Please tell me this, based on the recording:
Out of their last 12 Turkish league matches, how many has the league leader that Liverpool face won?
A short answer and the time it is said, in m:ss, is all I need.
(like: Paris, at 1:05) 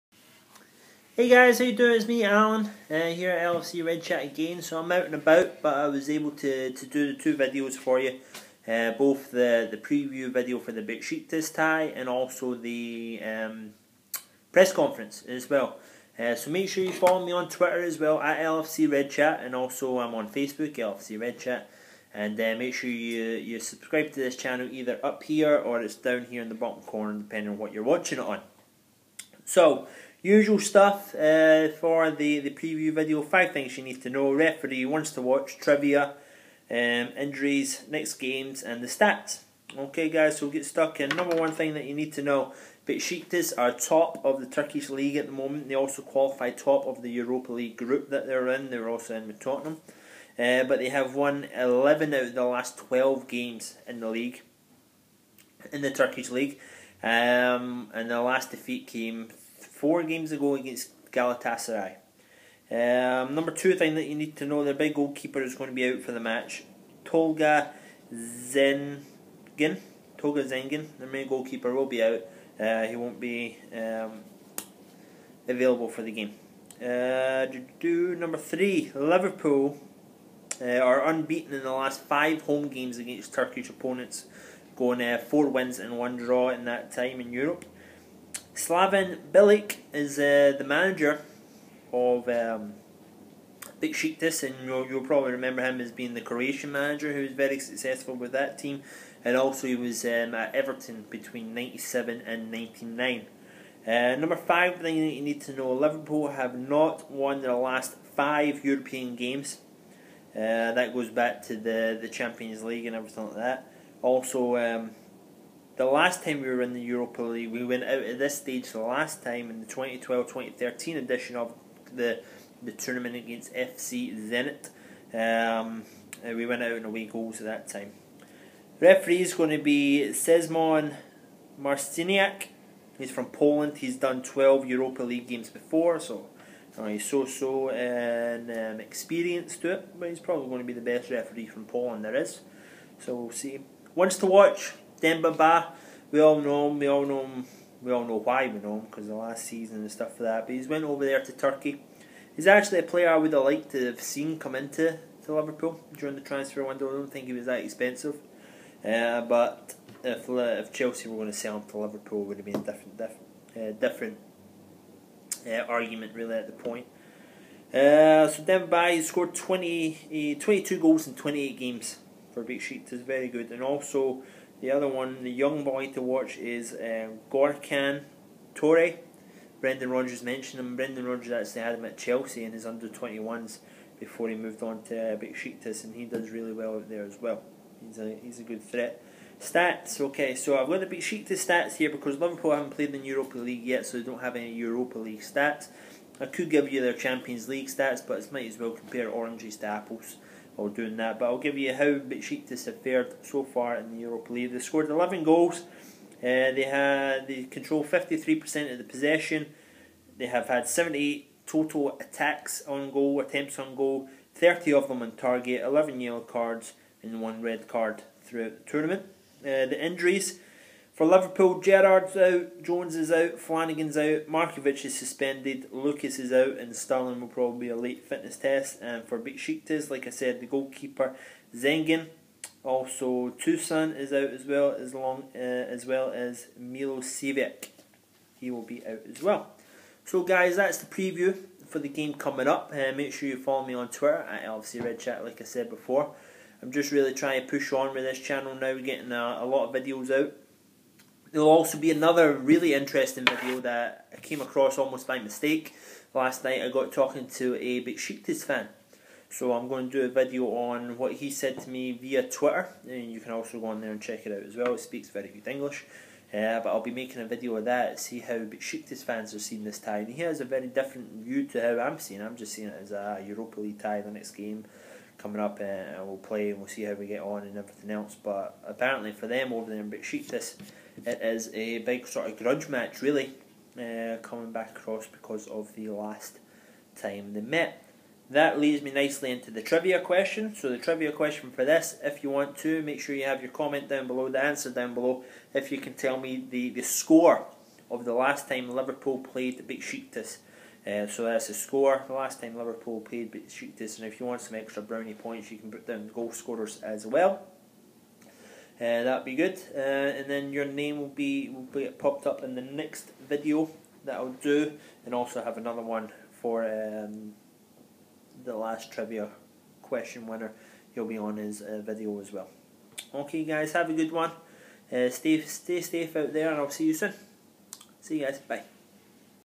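11, at 0:51.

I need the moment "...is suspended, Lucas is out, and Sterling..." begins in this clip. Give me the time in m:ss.
3:44.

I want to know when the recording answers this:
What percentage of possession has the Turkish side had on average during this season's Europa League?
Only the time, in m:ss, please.
3:27.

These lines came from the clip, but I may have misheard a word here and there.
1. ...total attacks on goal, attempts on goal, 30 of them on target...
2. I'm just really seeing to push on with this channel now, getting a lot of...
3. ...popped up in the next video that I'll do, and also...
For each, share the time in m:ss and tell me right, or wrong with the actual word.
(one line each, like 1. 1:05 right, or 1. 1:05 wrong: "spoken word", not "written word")
1. 3:31 right
2. 4:06 wrong: "trying", not "seeing"
3. 5:11 right.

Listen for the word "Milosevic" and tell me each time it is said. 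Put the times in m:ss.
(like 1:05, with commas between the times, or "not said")
3:56.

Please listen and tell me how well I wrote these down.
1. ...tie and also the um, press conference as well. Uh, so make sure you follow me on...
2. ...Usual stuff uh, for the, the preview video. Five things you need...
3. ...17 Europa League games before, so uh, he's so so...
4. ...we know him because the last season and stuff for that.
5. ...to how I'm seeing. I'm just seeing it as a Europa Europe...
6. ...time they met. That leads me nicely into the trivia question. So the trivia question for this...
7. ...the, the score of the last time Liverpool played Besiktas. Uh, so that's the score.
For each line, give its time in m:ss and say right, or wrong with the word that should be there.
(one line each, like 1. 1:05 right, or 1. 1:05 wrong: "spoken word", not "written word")
1. 0:11 right
2. 0:30 right
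3. 2:14 wrong: "12", not "17"
4. 2:28 right
5. 4:31 wrong: "League", not "Europe"
6. 4:46 right
7. 4:56 right.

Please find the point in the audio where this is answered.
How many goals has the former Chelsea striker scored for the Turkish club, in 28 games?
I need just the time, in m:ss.
2:50.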